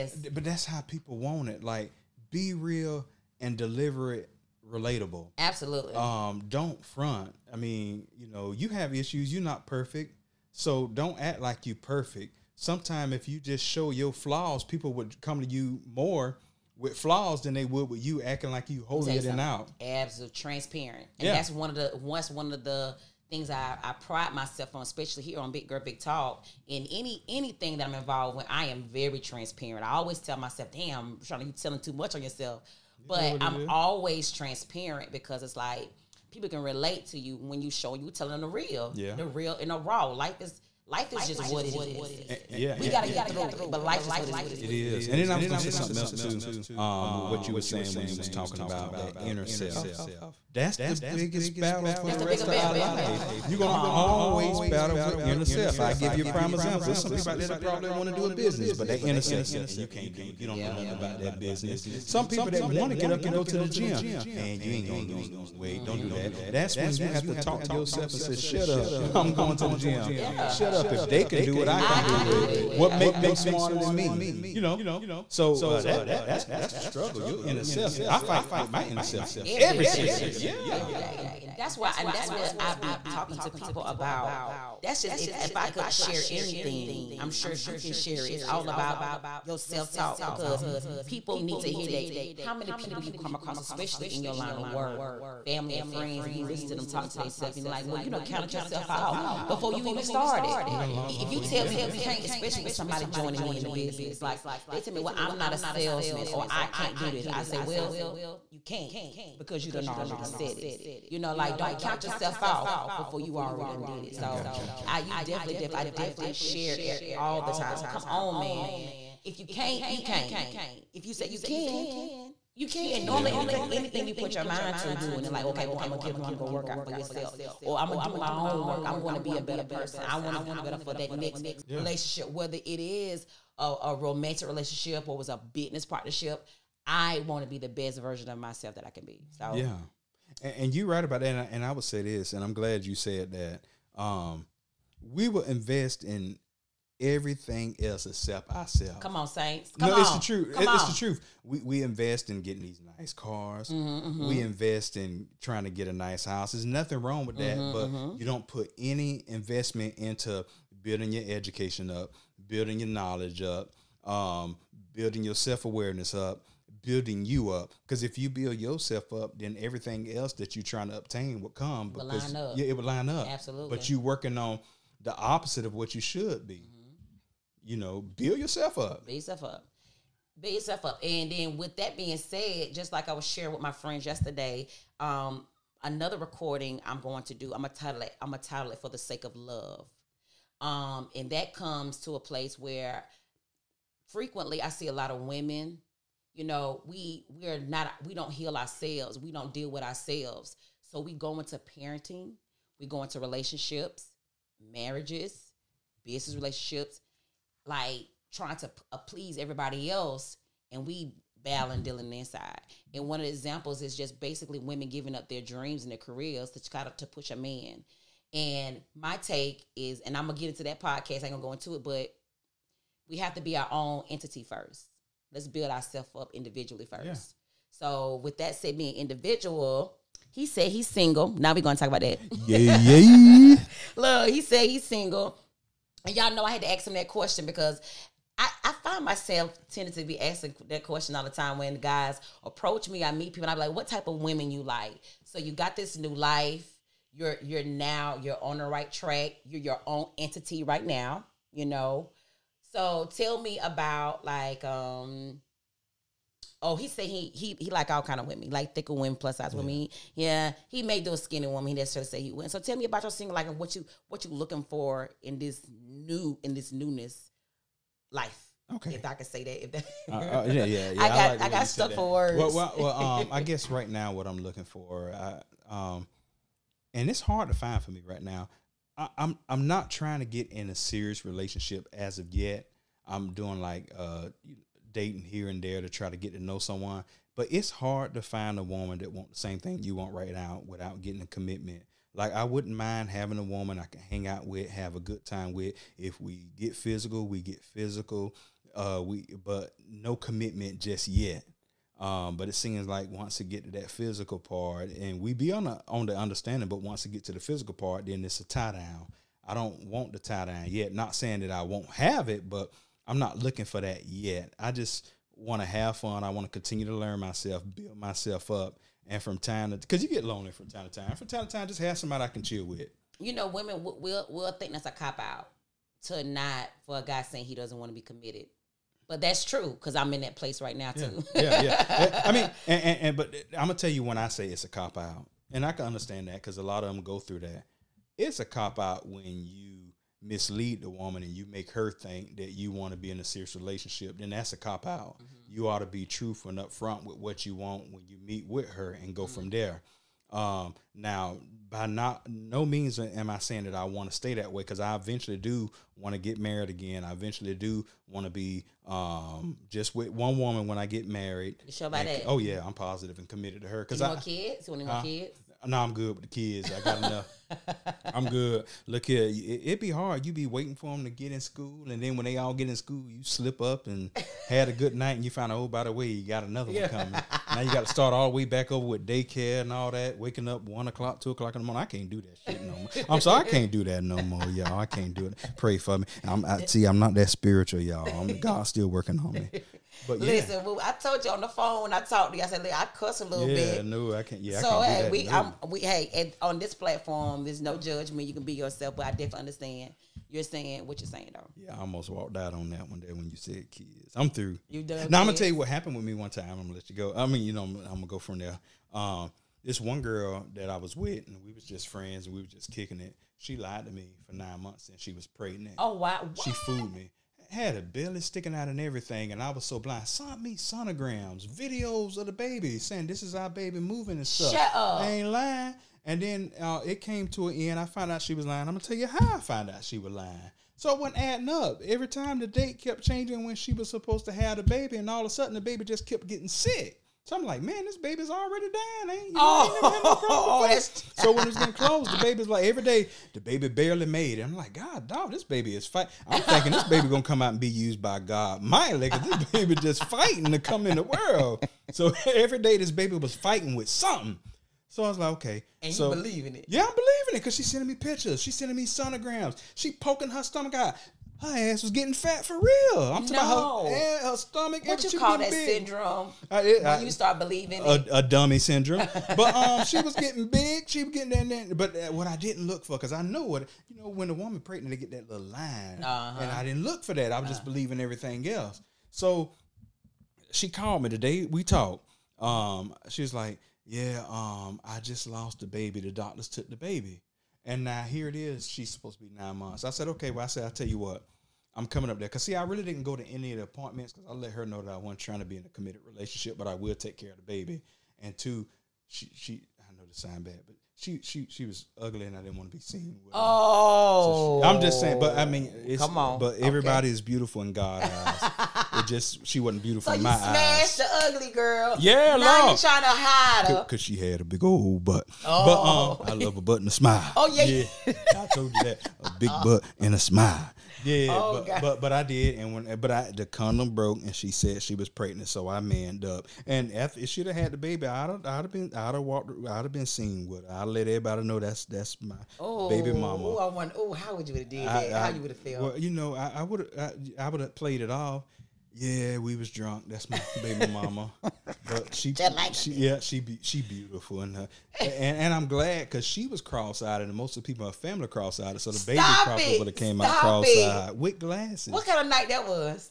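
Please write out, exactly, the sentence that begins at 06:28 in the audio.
I'm, God's still working on me.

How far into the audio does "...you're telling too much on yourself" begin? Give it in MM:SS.
00:31.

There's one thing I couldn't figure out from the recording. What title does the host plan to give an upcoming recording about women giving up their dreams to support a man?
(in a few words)
For the Sake of Love.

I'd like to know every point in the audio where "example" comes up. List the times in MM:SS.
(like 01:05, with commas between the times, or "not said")
00:56, 03:33.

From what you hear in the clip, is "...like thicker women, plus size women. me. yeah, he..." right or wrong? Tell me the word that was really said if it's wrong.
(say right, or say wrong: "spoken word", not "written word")
right.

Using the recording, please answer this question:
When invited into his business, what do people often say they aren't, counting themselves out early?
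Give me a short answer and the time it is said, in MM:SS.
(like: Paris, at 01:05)
a salesman, at 01:45.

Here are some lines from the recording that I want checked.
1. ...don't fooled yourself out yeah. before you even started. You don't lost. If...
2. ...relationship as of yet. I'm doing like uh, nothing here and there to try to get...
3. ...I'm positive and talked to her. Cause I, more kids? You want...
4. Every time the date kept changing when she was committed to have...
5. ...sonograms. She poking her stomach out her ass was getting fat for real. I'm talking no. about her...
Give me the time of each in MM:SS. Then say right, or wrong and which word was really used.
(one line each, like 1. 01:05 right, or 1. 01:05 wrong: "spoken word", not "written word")
1. 01:38 wrong: "counted", not "fooled"
2. 04:41 wrong: "dating", not "nothing"
3. 06:02 wrong: "committed", not "talked"
4. 07:11 wrong: "supposed", not "committed"
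5. 07:38 right.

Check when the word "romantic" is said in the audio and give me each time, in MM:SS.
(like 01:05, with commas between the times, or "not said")
02:13.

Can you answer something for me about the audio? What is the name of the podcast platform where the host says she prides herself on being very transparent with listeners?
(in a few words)
Big Girl Big Talk.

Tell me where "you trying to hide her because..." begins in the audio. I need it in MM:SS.
08:32.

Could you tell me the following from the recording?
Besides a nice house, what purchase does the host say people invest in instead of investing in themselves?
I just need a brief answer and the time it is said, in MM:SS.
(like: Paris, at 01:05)
nice cars, at 02:32.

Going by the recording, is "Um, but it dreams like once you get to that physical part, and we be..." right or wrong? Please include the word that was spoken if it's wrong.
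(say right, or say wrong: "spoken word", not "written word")
wrong: "seems", not "dreams".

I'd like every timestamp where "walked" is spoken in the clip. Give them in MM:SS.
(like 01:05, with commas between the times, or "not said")
06:42, 08:49.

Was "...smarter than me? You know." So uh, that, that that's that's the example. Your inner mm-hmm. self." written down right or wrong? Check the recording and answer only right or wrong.
wrong.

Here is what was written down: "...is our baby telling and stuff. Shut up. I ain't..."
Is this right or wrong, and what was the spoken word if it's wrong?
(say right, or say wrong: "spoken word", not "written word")
wrong: "moving", not "telling".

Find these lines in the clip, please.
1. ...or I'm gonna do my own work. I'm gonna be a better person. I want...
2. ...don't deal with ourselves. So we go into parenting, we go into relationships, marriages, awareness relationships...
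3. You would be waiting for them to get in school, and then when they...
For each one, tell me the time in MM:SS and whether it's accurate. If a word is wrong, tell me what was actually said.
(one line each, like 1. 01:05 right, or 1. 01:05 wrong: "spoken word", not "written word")
1. 02:07 right
2. 03:19 wrong: "business", not "awareness"
3. 06:10 right.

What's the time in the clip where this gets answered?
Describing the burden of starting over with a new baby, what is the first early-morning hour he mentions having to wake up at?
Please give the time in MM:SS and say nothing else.
06:20.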